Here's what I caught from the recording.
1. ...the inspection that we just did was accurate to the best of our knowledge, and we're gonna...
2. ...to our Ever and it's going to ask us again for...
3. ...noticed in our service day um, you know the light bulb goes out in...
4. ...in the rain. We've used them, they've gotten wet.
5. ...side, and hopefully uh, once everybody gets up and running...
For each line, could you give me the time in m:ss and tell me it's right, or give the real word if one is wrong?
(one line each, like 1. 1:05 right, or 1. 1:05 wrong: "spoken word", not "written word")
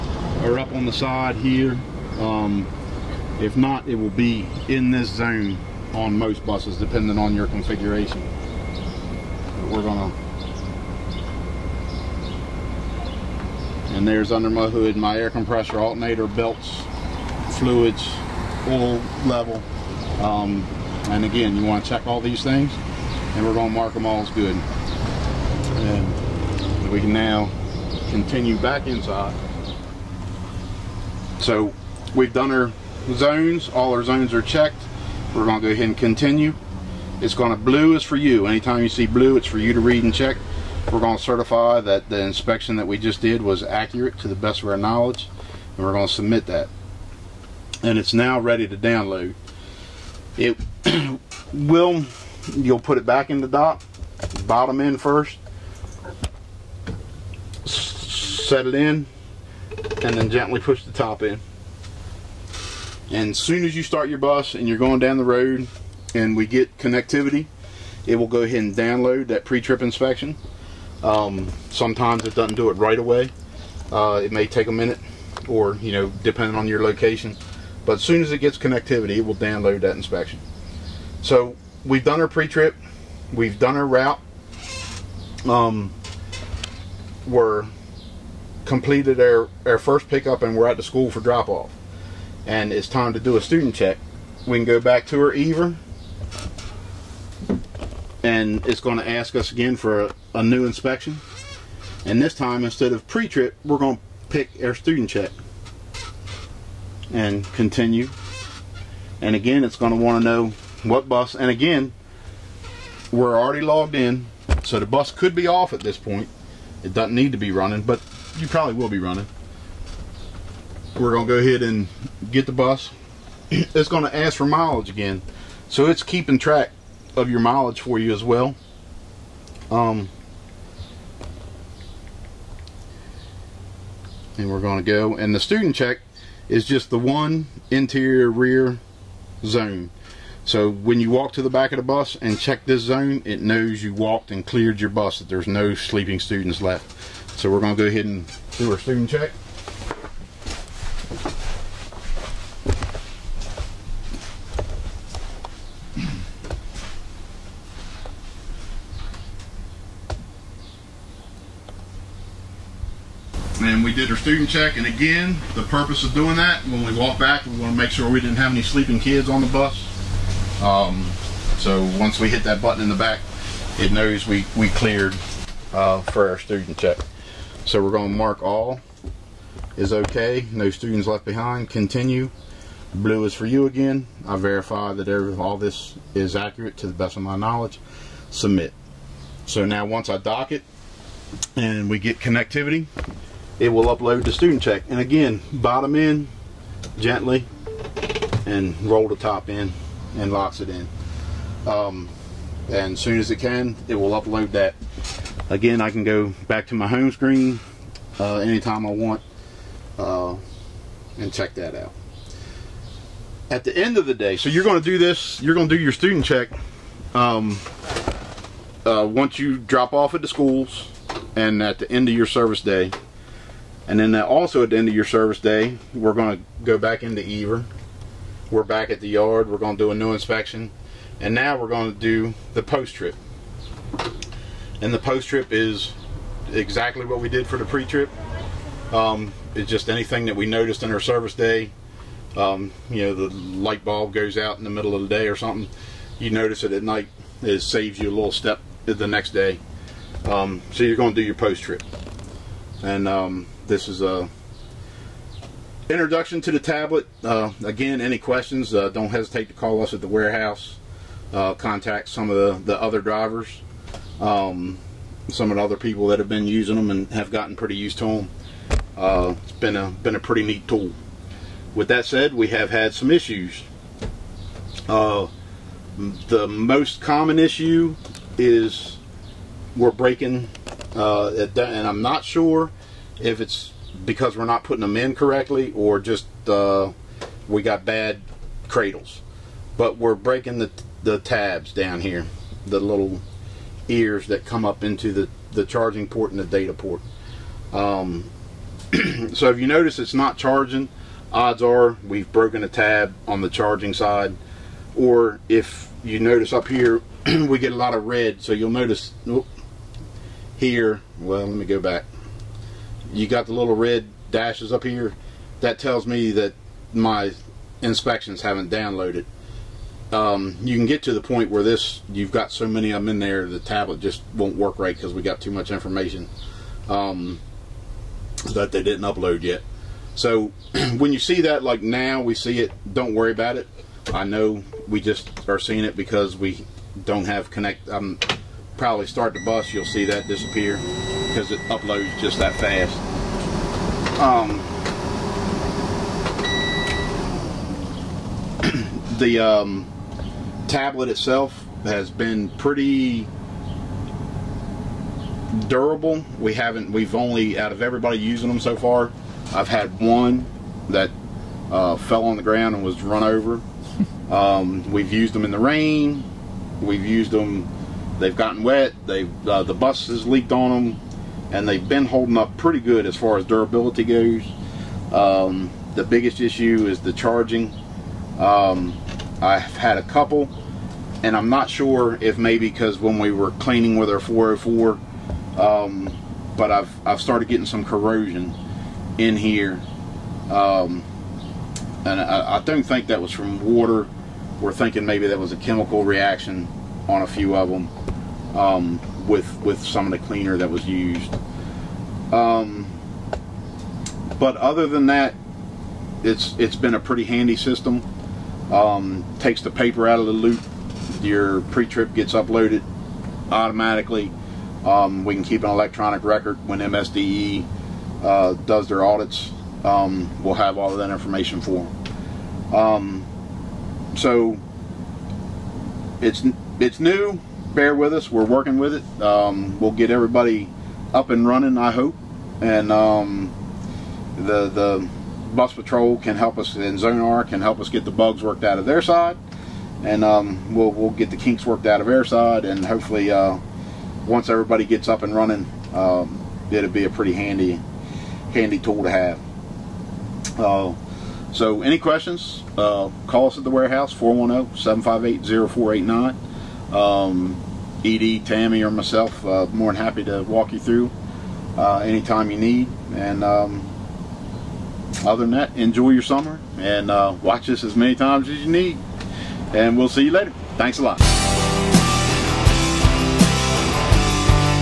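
1. 0:42 right
2. 1:35 right
3. 4:00 right
4. 6:05 right
5. 7:22 right.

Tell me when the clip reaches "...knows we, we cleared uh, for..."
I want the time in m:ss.
2:53.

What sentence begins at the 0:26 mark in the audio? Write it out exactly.
We can now continue back inside.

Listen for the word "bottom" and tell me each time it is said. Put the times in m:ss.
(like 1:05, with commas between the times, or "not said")
0:54, 3:15.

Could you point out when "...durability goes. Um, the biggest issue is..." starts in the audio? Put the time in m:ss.
6:13.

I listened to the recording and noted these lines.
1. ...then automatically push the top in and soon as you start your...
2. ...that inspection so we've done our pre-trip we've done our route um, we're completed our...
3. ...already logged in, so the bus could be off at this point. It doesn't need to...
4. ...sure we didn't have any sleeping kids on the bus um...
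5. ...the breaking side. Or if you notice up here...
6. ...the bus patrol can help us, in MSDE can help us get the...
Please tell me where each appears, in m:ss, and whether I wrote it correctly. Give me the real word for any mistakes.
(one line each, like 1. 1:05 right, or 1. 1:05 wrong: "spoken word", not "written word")
1. 1:00 wrong: "gently", not "automatically"
2. 1:19 right
3. 1:53 right
4. 2:47 right
5. 5:03 wrong: "charging", not "breaking"
6. 7:14 wrong: "Zonar", not "MSDE".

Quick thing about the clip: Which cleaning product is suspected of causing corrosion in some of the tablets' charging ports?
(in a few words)
404.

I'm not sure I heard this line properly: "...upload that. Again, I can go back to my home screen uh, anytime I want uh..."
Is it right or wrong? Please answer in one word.
right.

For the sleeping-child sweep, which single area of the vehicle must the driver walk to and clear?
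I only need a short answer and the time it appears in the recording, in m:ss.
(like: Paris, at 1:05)
Interior rear zone, at 2:17.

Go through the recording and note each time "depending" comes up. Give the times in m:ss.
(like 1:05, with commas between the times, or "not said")
0:06, 1:16.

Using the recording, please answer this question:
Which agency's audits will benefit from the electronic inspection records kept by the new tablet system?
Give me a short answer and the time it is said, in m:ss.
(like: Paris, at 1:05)
MSDE, at 6:56.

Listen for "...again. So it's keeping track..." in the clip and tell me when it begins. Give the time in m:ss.
2:04.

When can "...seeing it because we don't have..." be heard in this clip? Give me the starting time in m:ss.
5:35.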